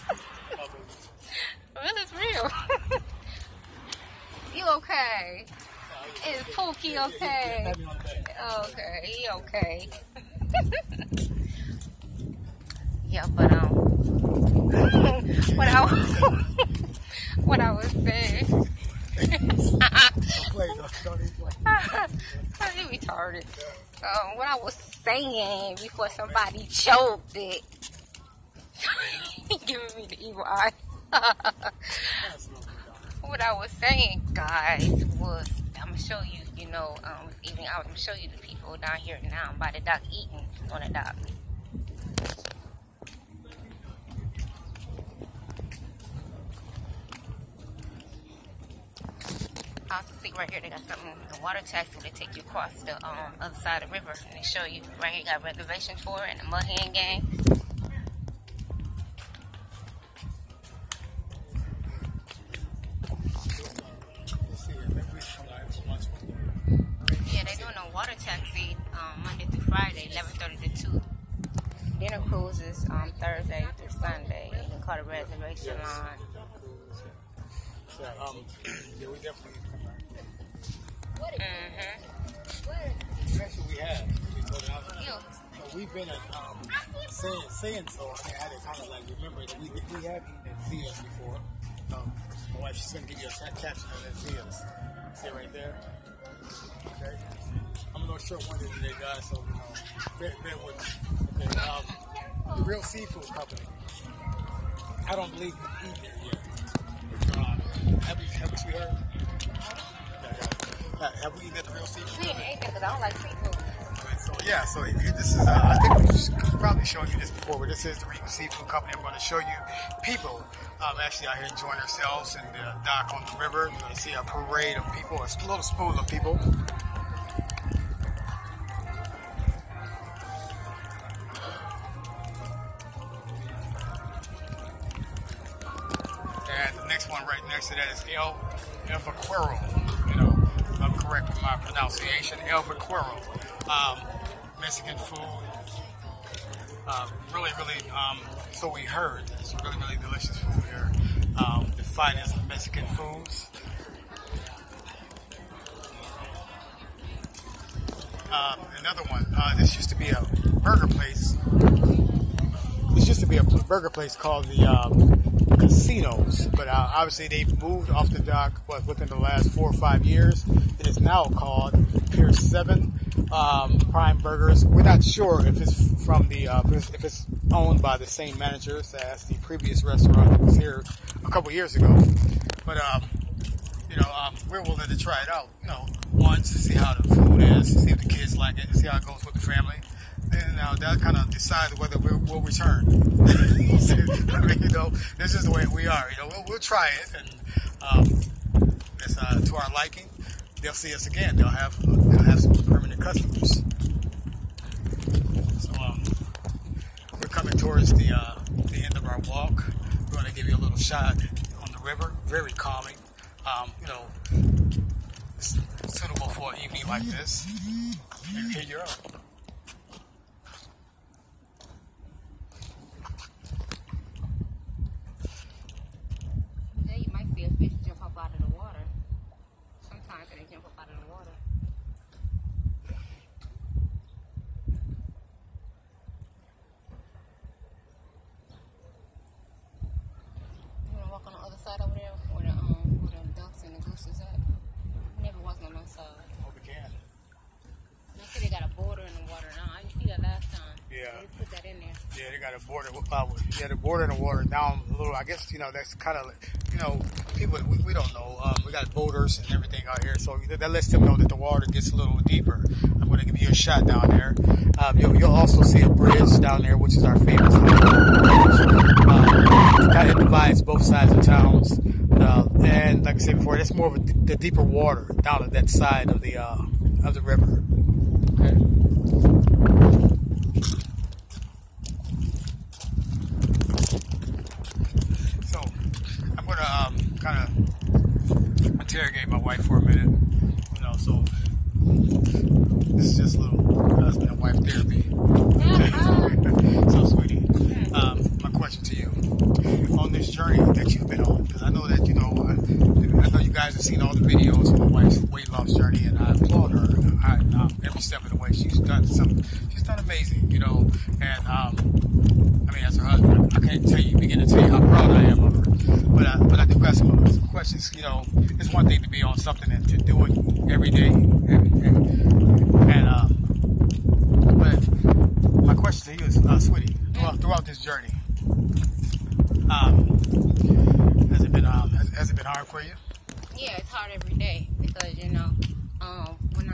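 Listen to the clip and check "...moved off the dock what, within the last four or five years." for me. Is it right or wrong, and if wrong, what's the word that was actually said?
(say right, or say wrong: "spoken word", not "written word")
right.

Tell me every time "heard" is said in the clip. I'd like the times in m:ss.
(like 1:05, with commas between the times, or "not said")
1:48, 2:28.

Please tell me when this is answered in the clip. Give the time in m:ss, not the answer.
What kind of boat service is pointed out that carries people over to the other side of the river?
0:51.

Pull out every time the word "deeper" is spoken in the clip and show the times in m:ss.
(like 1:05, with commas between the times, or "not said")
4:22, 4:34.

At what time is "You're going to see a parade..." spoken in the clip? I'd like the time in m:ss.
2:03.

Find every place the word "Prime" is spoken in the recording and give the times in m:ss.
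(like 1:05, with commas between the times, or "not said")
2:53.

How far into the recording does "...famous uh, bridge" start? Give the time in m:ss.
4:27.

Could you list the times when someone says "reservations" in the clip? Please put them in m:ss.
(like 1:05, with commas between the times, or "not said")
0:55, 1:15.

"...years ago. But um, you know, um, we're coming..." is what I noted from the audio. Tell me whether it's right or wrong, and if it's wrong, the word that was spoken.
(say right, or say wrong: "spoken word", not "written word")
wrong: "willing", not "coming".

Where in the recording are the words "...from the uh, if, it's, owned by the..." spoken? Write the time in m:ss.
2:56.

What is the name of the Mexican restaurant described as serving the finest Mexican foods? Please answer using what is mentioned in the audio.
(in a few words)
El Vaquero.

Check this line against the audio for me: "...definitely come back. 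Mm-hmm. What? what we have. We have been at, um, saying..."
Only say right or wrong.
right.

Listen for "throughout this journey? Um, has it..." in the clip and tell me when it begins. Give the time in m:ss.
5:27.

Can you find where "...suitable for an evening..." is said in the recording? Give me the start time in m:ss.
3:35.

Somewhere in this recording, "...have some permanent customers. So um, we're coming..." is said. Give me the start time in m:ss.
3:22.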